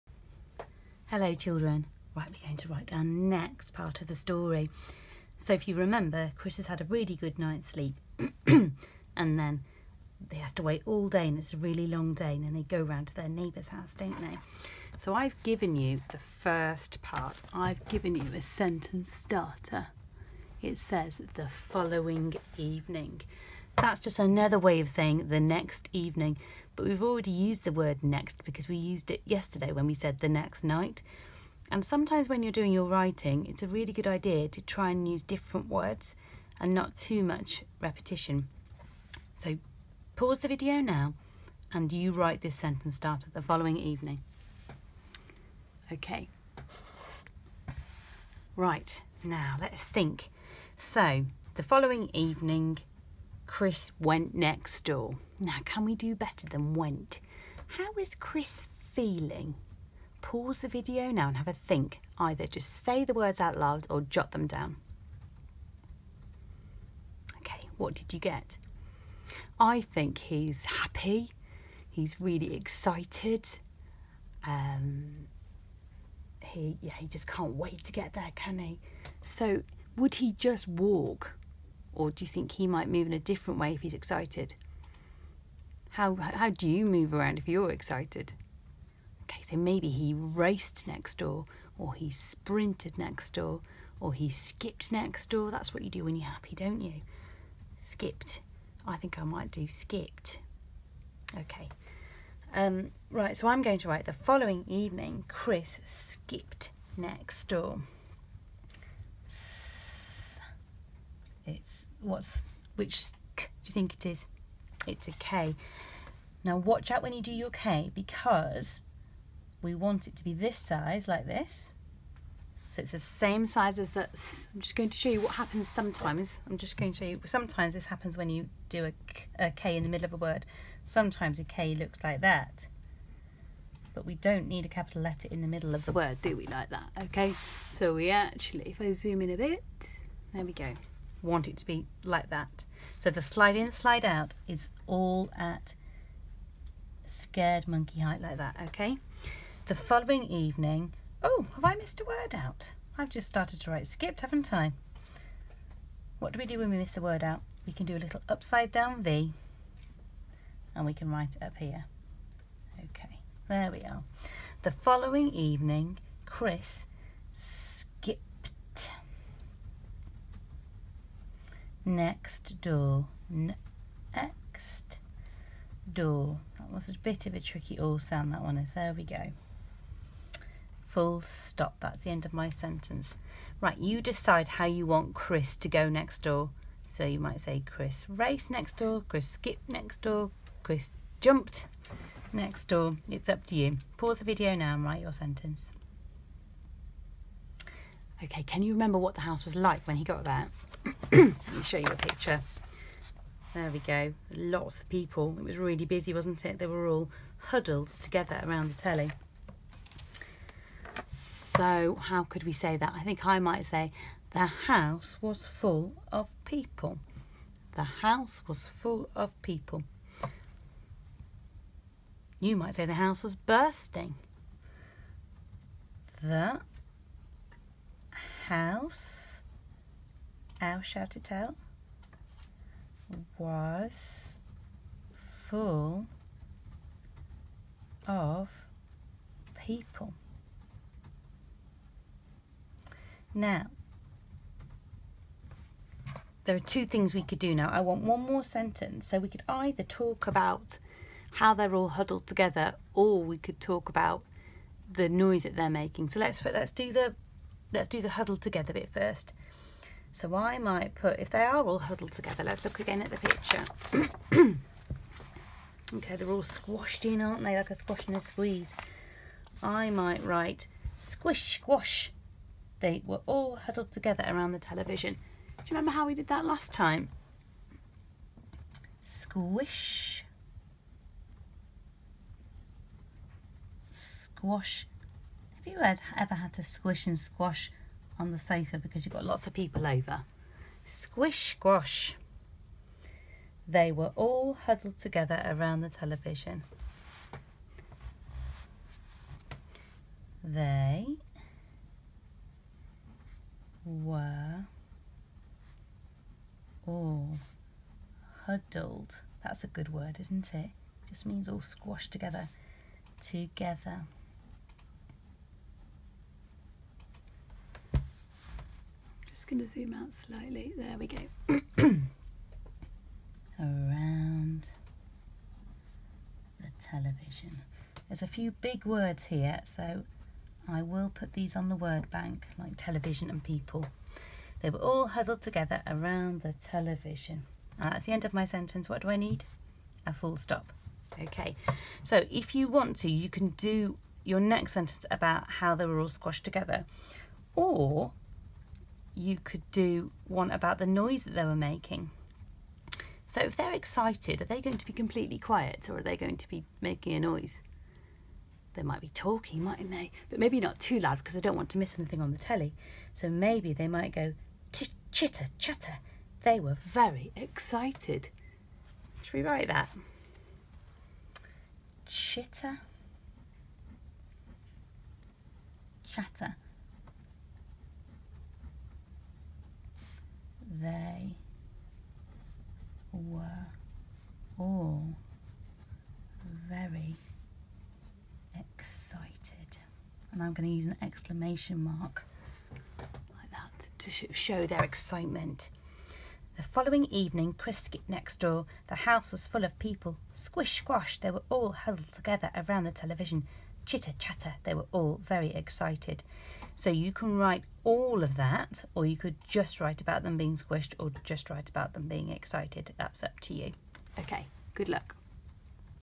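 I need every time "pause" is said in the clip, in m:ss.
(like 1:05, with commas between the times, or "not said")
0:40, 1:00, 3:13.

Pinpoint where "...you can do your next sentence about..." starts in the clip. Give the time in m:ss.
5:43.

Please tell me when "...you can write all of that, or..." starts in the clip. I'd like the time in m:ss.
6:46.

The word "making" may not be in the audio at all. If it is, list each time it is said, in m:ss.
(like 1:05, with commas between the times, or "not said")
4:15, 5:51, 5:56.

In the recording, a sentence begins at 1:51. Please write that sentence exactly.
It's what's which do you think it is?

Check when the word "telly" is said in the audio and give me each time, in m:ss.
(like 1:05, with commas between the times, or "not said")
3:28, 6:02.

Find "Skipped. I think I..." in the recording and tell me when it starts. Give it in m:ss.
1:37.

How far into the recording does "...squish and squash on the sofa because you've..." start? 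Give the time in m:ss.
4:46.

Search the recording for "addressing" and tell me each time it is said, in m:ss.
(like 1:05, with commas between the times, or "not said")
not said.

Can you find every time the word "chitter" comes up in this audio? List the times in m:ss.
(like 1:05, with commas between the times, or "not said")
6:05, 6:12, 6:43.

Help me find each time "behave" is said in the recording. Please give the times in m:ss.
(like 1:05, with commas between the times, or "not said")
not said.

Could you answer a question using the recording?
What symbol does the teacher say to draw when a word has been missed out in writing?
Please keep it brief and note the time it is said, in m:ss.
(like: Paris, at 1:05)
upside down V, at 2:38.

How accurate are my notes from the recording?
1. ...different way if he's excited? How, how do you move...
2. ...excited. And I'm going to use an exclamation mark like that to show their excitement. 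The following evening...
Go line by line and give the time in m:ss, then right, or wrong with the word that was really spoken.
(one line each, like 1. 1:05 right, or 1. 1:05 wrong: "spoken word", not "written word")
1. 1:23 right
2. 6:28 right.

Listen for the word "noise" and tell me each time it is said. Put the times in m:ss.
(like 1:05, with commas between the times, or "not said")
4:15, 5:50, 5:57.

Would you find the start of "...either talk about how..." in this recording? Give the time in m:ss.
4:09.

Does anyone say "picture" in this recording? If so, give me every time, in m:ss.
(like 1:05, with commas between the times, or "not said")
3:21, 4:23.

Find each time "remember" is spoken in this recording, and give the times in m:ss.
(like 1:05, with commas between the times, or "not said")
0:05, 3:18, 4:35.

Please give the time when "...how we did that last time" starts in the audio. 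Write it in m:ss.
4:35.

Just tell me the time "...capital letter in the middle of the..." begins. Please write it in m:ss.
2:14.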